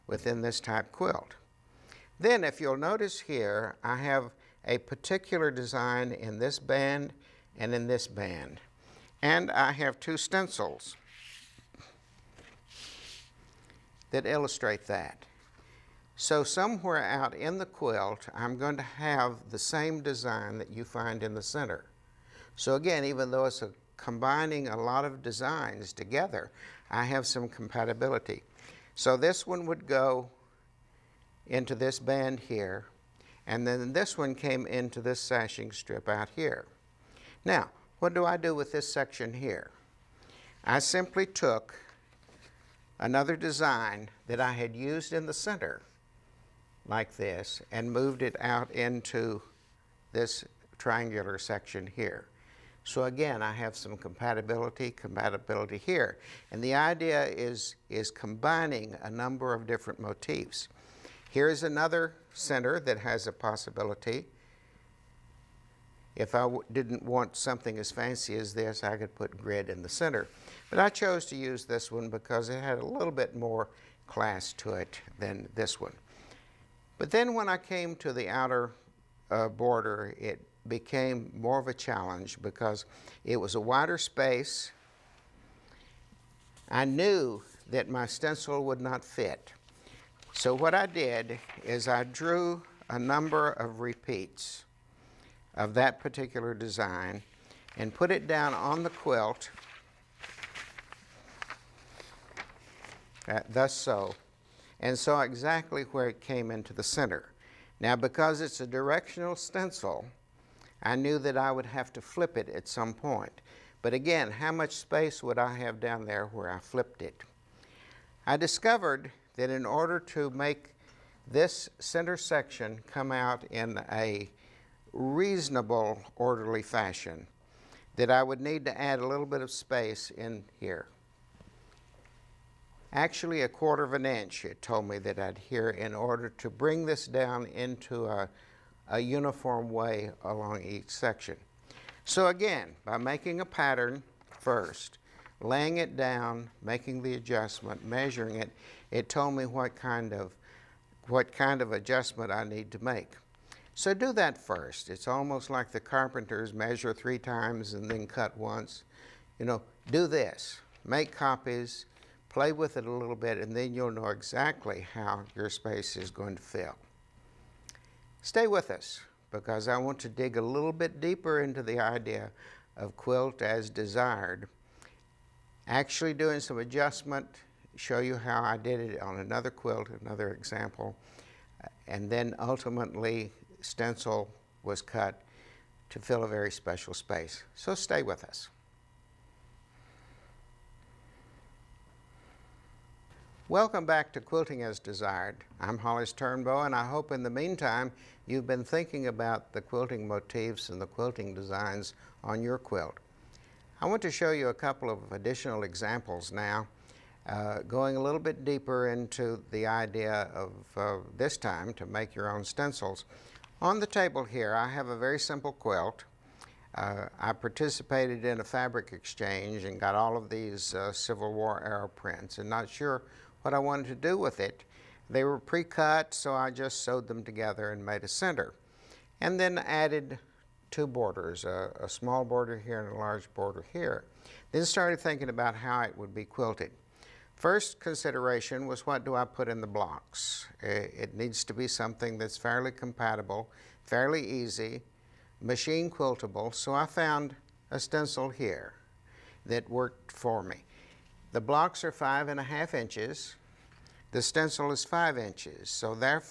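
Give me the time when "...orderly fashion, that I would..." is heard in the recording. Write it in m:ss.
2:06.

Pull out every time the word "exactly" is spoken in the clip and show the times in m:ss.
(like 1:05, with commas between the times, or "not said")
1:45, 2:44.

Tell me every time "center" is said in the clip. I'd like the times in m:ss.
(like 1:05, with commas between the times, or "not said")
0:21, 0:45, 1:02, 1:09, 1:46, 2:01, 3:48.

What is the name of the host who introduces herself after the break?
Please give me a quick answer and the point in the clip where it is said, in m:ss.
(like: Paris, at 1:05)
Hollis Turnbow, at 3:15.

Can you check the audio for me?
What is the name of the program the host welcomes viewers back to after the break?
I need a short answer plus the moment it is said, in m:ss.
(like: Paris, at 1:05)
Quilting as Desired, at 3:14.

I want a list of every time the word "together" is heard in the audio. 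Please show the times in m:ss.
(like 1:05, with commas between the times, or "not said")
0:25, 3:47.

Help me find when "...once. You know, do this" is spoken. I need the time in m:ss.
2:38.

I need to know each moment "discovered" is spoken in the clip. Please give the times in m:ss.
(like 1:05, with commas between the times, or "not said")
1:58.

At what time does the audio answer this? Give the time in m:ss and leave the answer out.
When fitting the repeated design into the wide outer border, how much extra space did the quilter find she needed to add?
2:13.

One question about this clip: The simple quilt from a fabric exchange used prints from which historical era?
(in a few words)
Civil War.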